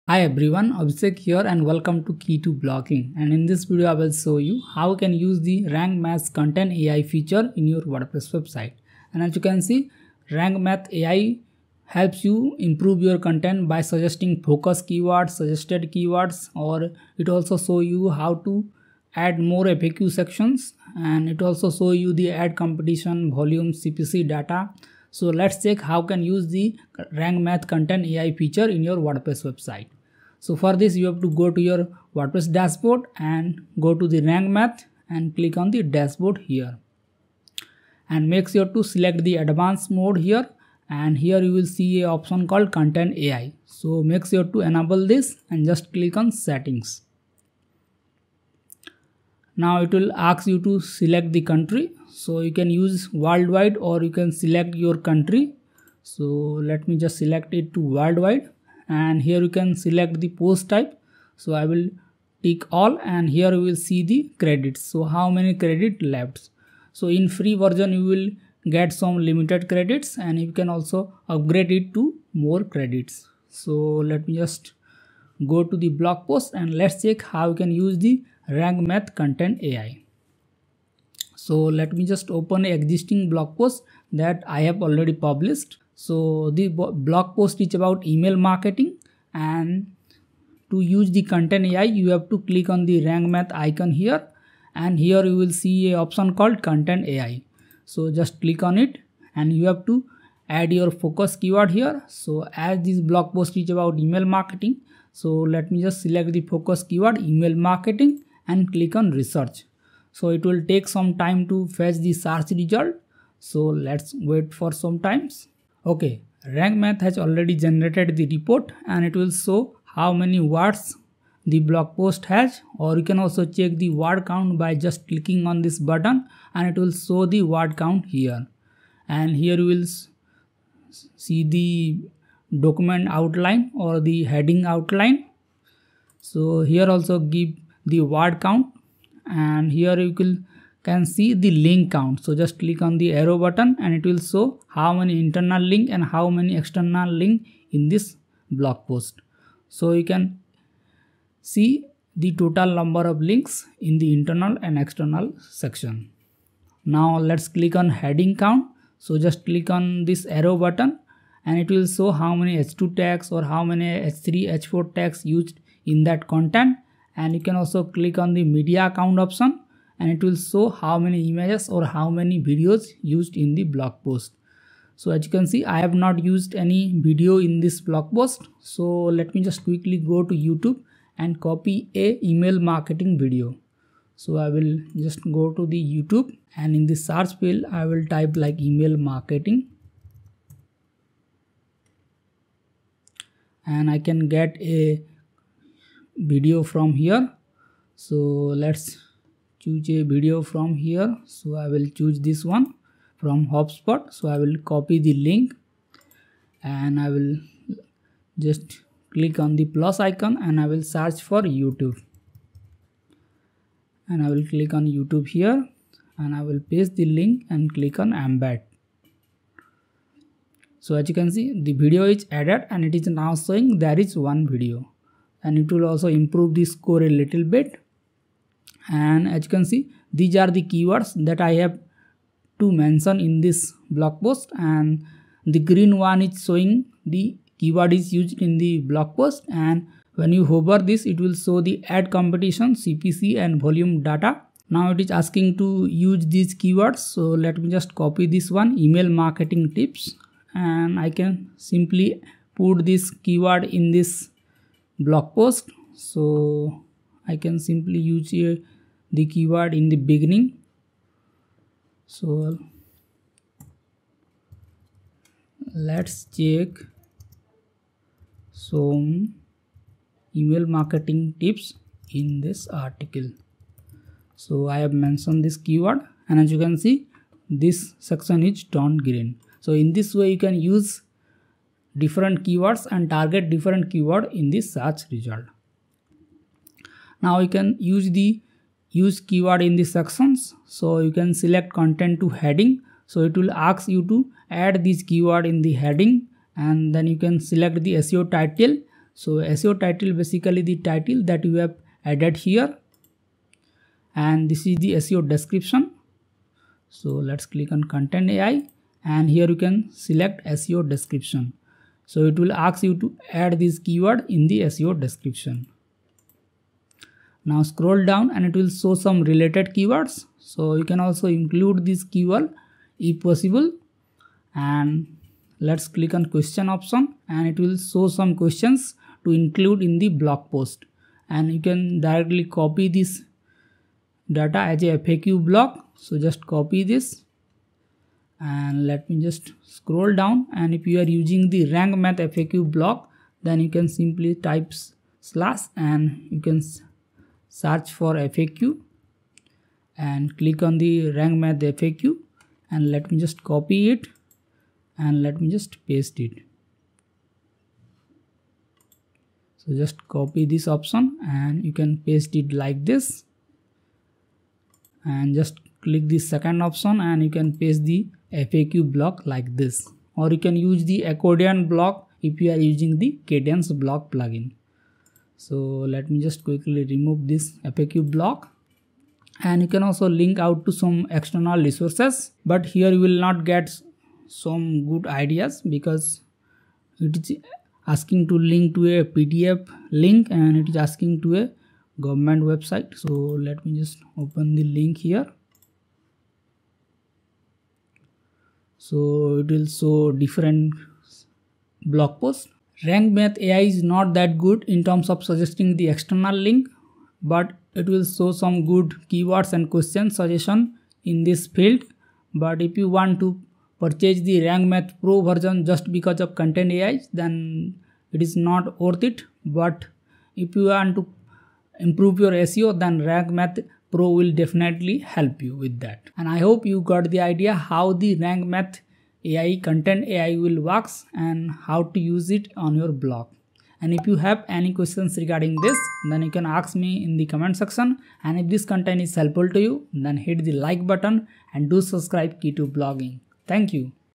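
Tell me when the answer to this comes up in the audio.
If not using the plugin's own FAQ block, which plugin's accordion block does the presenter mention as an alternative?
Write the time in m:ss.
6:13.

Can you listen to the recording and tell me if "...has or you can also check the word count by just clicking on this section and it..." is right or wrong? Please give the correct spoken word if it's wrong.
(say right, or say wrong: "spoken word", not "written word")
wrong: "button", not "section".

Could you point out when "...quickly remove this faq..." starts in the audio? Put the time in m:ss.
6:16.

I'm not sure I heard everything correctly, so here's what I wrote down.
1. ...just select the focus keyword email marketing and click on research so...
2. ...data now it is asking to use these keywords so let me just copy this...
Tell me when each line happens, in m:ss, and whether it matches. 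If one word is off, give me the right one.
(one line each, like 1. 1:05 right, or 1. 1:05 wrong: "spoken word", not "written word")
1. 1:45 right
2. 4:04 right.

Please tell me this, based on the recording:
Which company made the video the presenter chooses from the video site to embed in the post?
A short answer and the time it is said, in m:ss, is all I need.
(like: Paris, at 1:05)
HubSpot, at 3:23.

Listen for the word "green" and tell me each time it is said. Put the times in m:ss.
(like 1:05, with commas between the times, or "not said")
3:55, 4:39.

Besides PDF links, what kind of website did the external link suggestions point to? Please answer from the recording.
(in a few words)
A government website.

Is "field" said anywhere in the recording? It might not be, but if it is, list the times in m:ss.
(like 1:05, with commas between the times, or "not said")
3:07, 6:51.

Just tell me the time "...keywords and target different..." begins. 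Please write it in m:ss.
4:42.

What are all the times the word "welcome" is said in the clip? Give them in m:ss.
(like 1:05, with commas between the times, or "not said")
0:01.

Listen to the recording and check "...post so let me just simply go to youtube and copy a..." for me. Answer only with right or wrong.
wrong.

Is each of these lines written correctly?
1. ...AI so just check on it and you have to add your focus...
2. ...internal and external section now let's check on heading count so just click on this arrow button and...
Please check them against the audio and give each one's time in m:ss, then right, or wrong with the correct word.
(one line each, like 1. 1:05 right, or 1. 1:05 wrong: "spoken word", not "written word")
1. 1:37 wrong: "click", not "check"
2. 2:34 wrong: "click", not "check".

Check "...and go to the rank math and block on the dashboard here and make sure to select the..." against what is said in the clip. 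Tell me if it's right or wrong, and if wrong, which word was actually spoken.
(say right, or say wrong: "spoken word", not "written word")
wrong: "click", not "block".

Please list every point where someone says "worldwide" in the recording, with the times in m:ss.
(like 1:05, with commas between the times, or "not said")
0:53, 0:57.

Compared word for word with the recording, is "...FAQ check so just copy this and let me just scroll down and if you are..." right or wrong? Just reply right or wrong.
wrong.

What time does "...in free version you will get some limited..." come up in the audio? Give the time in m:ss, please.
1:07.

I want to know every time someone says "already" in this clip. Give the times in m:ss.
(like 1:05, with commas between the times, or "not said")
1:24, 1:57.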